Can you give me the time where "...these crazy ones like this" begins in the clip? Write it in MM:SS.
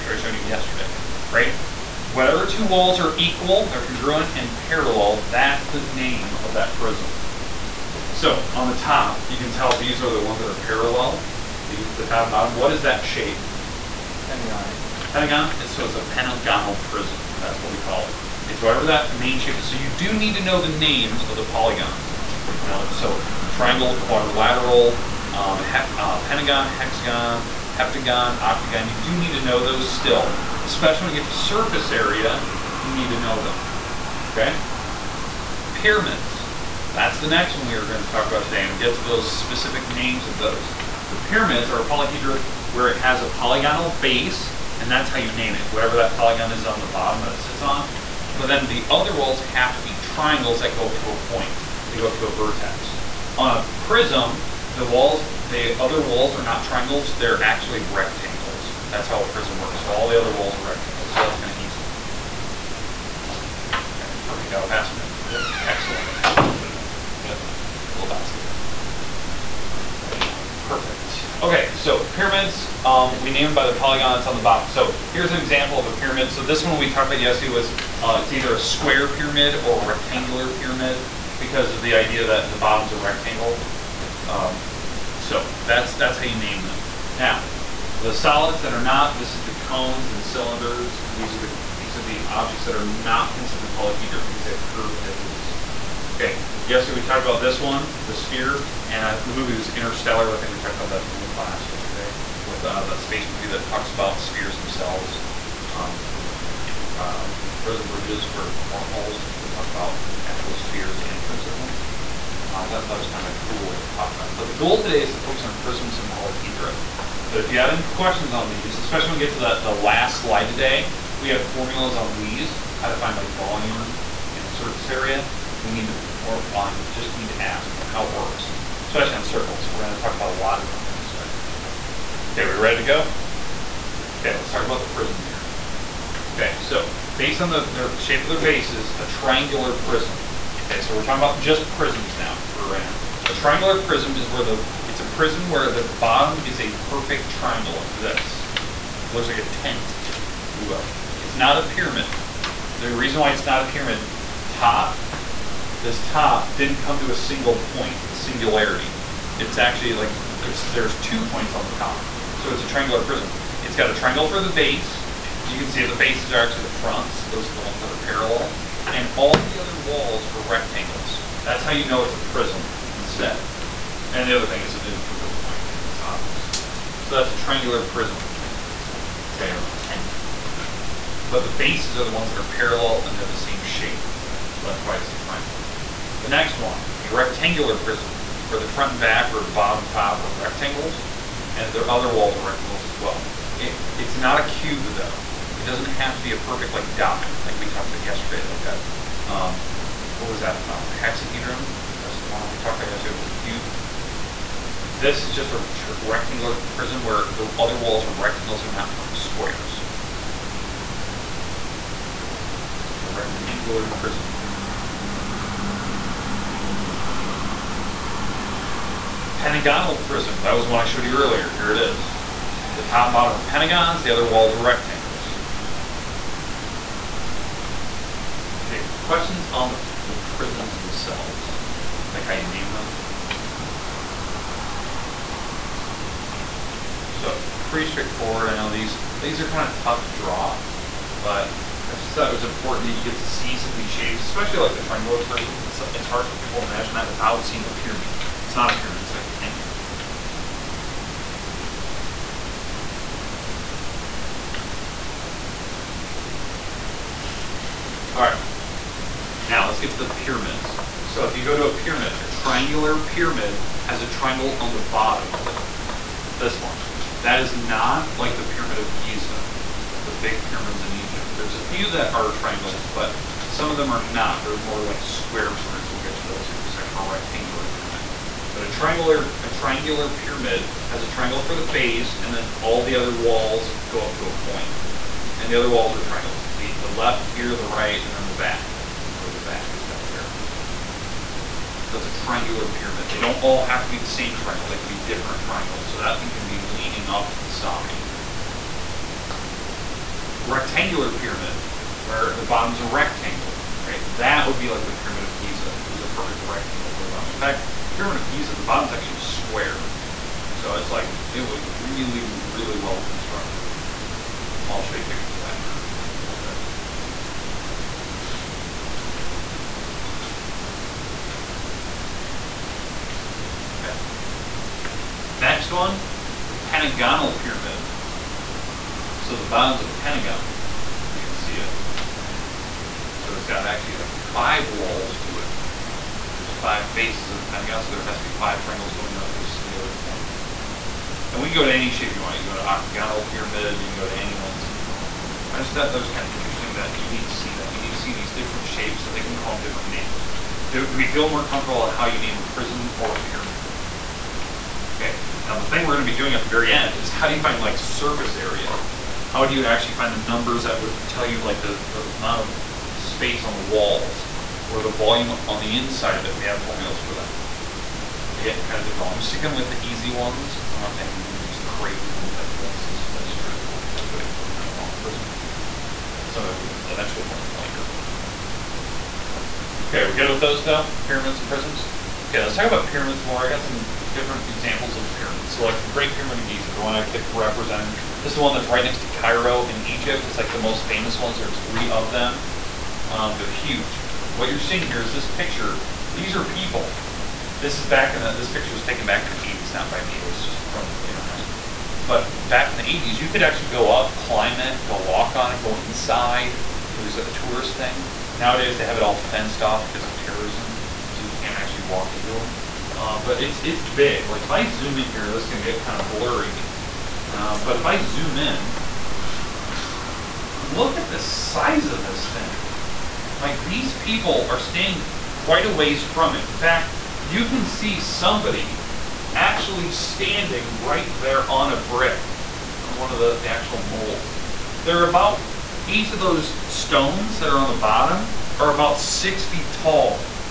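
06:11.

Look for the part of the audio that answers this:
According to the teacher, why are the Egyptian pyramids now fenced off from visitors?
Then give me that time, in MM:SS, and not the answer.
06:50.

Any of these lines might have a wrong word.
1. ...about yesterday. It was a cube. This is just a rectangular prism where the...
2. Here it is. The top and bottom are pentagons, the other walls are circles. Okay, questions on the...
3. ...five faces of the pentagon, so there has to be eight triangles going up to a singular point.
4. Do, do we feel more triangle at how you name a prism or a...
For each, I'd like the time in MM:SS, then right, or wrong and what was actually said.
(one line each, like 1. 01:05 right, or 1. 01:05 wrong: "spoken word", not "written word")
1. 03:22 right
2. 03:41 wrong: "rectangles", not "circles"
3. 05:36 wrong: "five", not "eight"
4. 05:50 wrong: "comfortable", not "triangle".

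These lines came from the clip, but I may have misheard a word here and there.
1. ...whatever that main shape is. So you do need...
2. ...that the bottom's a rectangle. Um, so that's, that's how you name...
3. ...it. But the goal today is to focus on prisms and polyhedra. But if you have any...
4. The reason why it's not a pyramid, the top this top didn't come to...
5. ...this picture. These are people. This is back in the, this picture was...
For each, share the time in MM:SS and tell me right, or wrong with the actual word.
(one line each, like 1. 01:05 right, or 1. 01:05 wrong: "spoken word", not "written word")
1. 00:18 right
2. 01:22 right
3. 01:54 right
4. 02:32 right
5. 06:35 right.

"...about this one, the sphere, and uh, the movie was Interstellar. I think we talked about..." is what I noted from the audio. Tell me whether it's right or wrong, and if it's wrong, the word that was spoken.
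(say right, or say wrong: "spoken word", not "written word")
right.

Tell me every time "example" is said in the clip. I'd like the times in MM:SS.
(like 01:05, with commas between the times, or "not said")
01:15, 06:24.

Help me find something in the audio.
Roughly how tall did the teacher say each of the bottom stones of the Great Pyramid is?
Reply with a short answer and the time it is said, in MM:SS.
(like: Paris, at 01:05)
6 feet, at 07:18.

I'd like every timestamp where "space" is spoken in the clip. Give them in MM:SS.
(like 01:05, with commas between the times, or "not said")
01:43, 06:02.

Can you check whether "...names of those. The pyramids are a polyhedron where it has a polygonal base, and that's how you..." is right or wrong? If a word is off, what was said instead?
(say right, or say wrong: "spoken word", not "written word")
right.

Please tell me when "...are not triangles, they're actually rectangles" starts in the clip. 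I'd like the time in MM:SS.
00:56.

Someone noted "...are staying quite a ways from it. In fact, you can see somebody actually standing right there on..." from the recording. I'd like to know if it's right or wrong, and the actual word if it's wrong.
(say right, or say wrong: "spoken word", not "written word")
right.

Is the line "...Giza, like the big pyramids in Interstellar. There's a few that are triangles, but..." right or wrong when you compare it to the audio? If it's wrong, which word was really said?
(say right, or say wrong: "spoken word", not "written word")
wrong: "Egypt", not "Interstellar".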